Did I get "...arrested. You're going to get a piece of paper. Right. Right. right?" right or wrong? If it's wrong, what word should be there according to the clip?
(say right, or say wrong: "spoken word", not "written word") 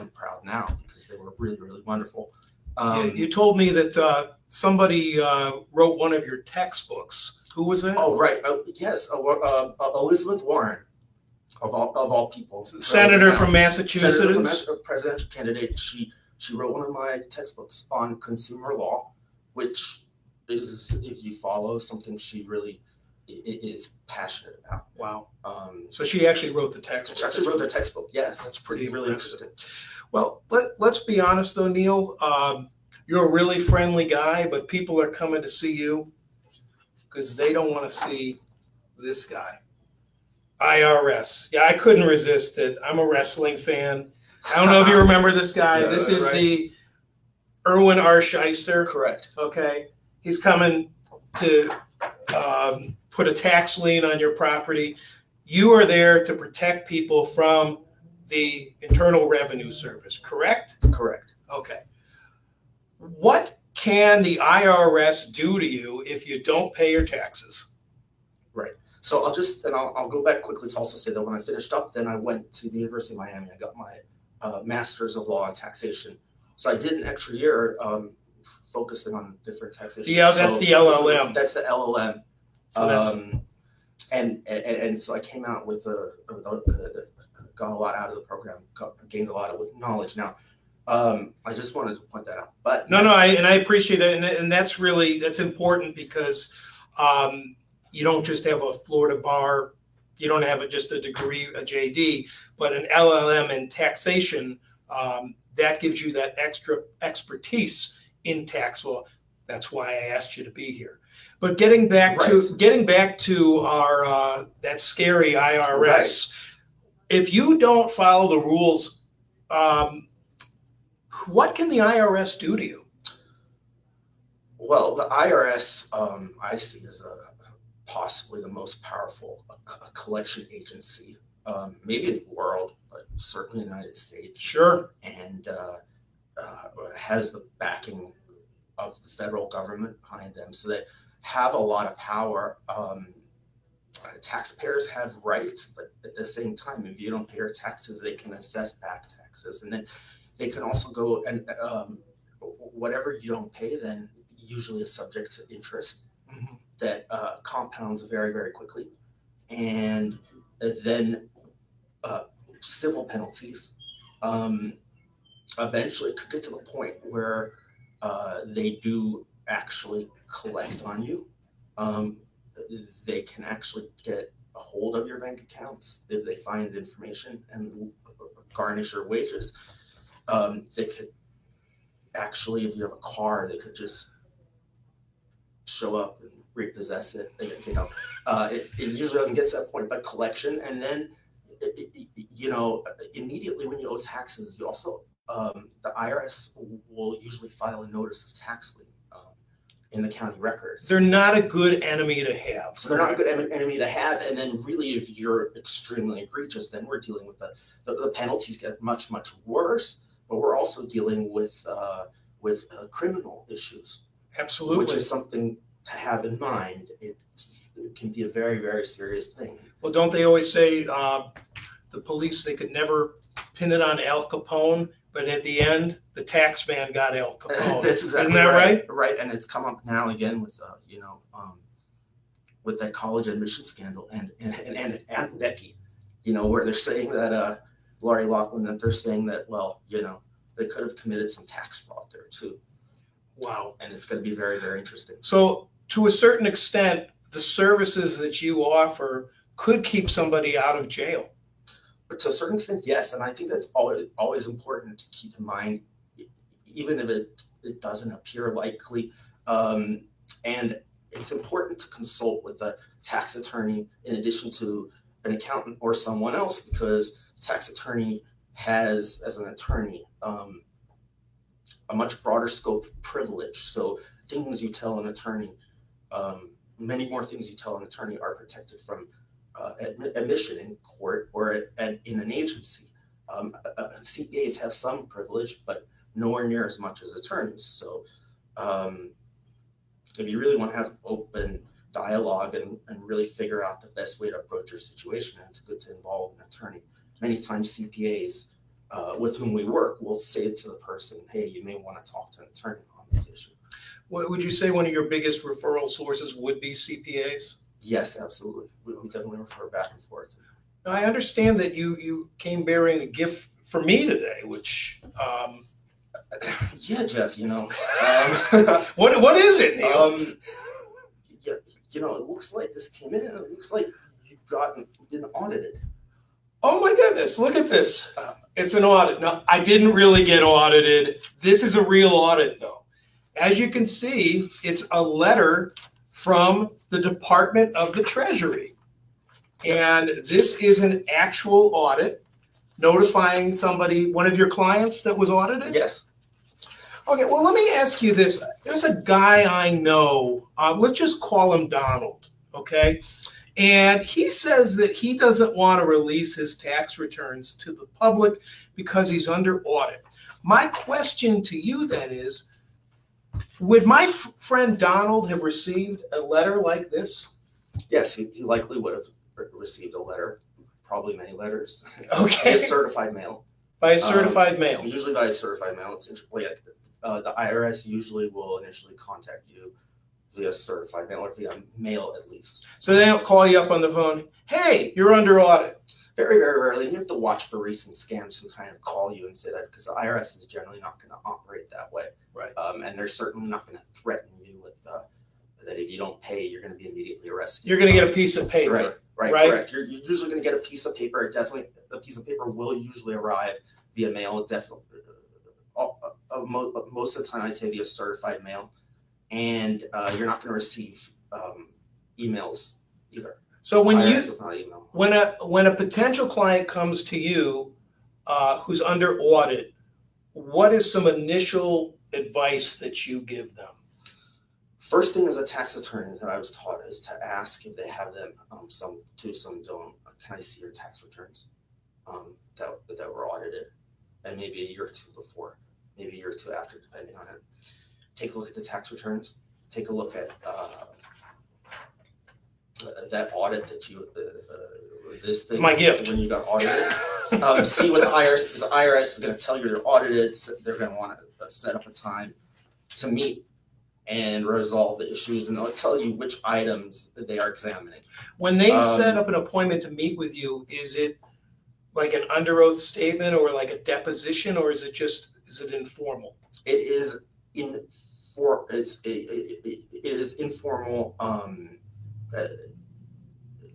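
right.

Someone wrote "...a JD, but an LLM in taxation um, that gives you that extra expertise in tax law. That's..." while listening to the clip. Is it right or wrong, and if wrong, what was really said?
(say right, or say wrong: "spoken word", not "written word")
right.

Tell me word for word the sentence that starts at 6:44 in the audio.
Definitely, uh, uh, most of the time, I'd say via certified mail and uh, you're not going to receive um, emails either.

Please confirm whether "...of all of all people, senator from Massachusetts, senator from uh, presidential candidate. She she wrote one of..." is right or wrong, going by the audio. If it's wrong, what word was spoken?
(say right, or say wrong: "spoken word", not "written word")
right.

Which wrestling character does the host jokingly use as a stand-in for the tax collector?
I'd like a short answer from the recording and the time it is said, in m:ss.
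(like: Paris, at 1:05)
Irwin R. Schyster, at 0:47.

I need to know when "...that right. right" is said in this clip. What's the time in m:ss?
3:48.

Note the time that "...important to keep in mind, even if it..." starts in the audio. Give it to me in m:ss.
4:14.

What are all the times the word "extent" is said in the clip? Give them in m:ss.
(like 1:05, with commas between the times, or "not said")
4:06, 4:12.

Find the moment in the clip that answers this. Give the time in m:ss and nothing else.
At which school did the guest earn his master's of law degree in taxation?
1:12.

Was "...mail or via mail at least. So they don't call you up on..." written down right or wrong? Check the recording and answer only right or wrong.
right.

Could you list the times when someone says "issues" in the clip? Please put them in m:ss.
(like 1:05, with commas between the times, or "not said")
3:33, 5:03, 7:35.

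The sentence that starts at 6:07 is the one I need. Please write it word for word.
Yes, he, he likely would have received a letter, probably many letters.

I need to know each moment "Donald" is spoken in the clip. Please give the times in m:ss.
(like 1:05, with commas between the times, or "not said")
5:51, 6:04.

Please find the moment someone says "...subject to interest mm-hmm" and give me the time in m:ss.
2:34.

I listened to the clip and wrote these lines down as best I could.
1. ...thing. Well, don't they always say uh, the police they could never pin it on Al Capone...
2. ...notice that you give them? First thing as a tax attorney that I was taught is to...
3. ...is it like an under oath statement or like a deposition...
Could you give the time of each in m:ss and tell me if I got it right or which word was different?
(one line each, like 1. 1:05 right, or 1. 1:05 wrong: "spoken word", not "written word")
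1. 3:39 right
2. 7:02 wrong: "advice", not "notice"
3. 7:40 right.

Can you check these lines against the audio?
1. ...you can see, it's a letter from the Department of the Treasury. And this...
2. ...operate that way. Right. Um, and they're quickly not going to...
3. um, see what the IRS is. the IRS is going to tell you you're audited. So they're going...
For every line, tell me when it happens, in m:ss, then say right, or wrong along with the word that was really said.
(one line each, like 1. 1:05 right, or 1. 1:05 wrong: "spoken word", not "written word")
1. 5:33 right
2. 6:31 wrong: "certainly", not "quickly"
3. 7:27 right.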